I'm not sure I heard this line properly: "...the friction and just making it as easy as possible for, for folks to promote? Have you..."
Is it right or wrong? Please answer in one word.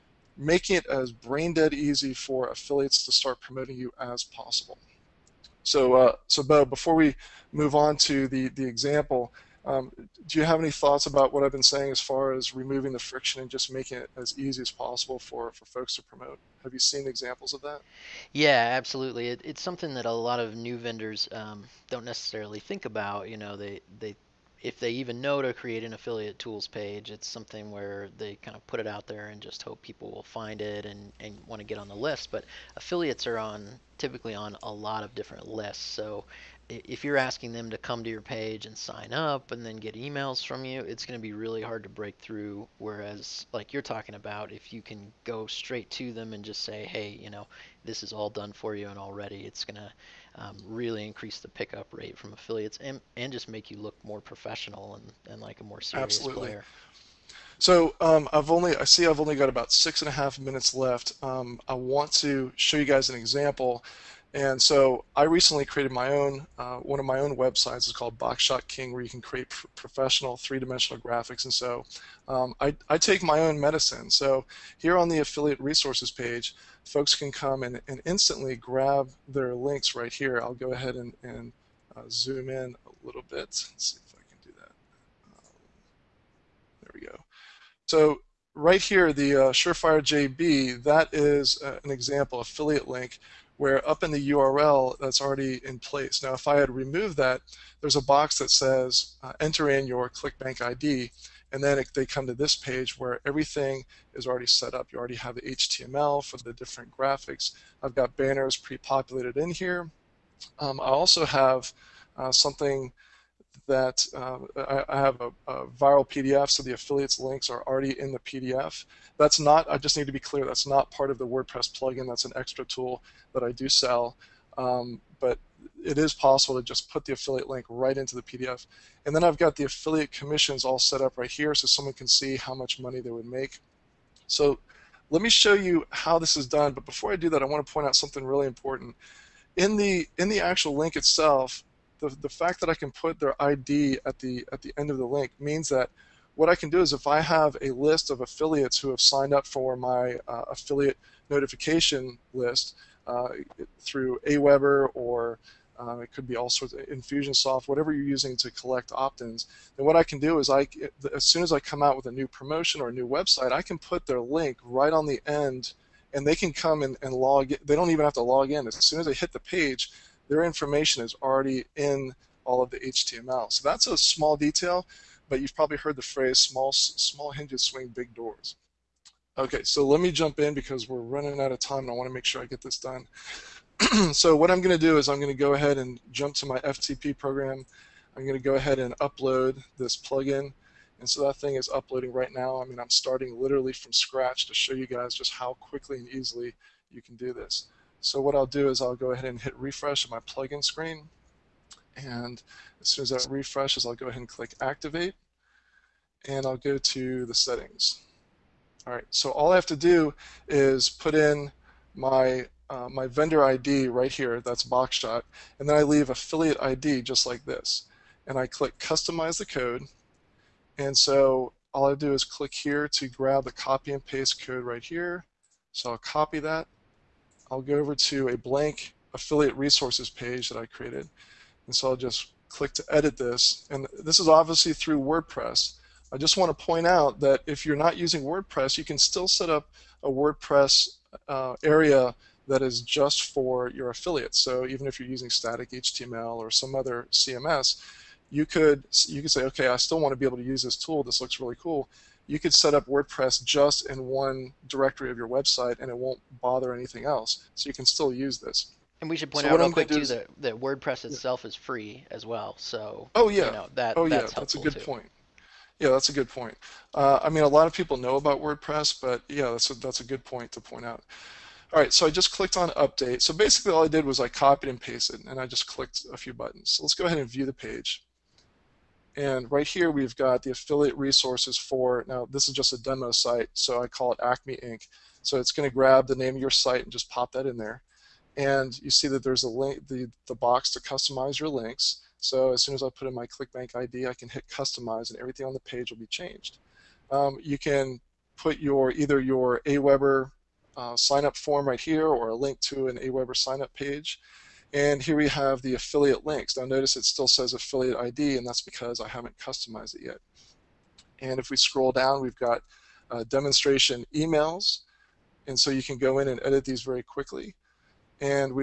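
right.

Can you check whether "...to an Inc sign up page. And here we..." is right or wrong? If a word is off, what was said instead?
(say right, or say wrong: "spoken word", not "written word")
wrong: "AWeber", not "Inc".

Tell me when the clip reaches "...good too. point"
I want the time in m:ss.
4:24.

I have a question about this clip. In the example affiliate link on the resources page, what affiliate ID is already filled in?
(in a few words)
Surefire JB.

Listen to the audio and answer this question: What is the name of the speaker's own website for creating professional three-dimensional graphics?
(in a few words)
Boxshot King.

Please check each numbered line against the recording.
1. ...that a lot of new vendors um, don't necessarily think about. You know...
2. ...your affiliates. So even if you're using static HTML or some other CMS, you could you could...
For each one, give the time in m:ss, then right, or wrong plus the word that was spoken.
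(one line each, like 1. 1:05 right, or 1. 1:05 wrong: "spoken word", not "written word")
1. 0:19 right
2. 4:03 right.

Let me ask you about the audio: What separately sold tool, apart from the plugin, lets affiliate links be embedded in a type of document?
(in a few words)
Viral PDF.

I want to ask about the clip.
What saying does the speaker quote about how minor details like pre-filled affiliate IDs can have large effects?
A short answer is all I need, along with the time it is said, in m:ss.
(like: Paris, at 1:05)
Small hinges swing big doors, at 2:56.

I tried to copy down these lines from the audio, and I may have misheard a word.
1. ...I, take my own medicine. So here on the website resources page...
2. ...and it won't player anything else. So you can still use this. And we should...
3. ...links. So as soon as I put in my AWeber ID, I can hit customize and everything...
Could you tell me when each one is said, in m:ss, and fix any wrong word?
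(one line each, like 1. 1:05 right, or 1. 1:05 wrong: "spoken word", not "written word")
1. 1:12 wrong: "affiliate", not "website"
2. 4:15 wrong: "bother", not "player"
3. 4:51 wrong: "ClickBank", not "AWeber".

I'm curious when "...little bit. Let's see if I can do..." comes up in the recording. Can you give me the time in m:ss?
1:23.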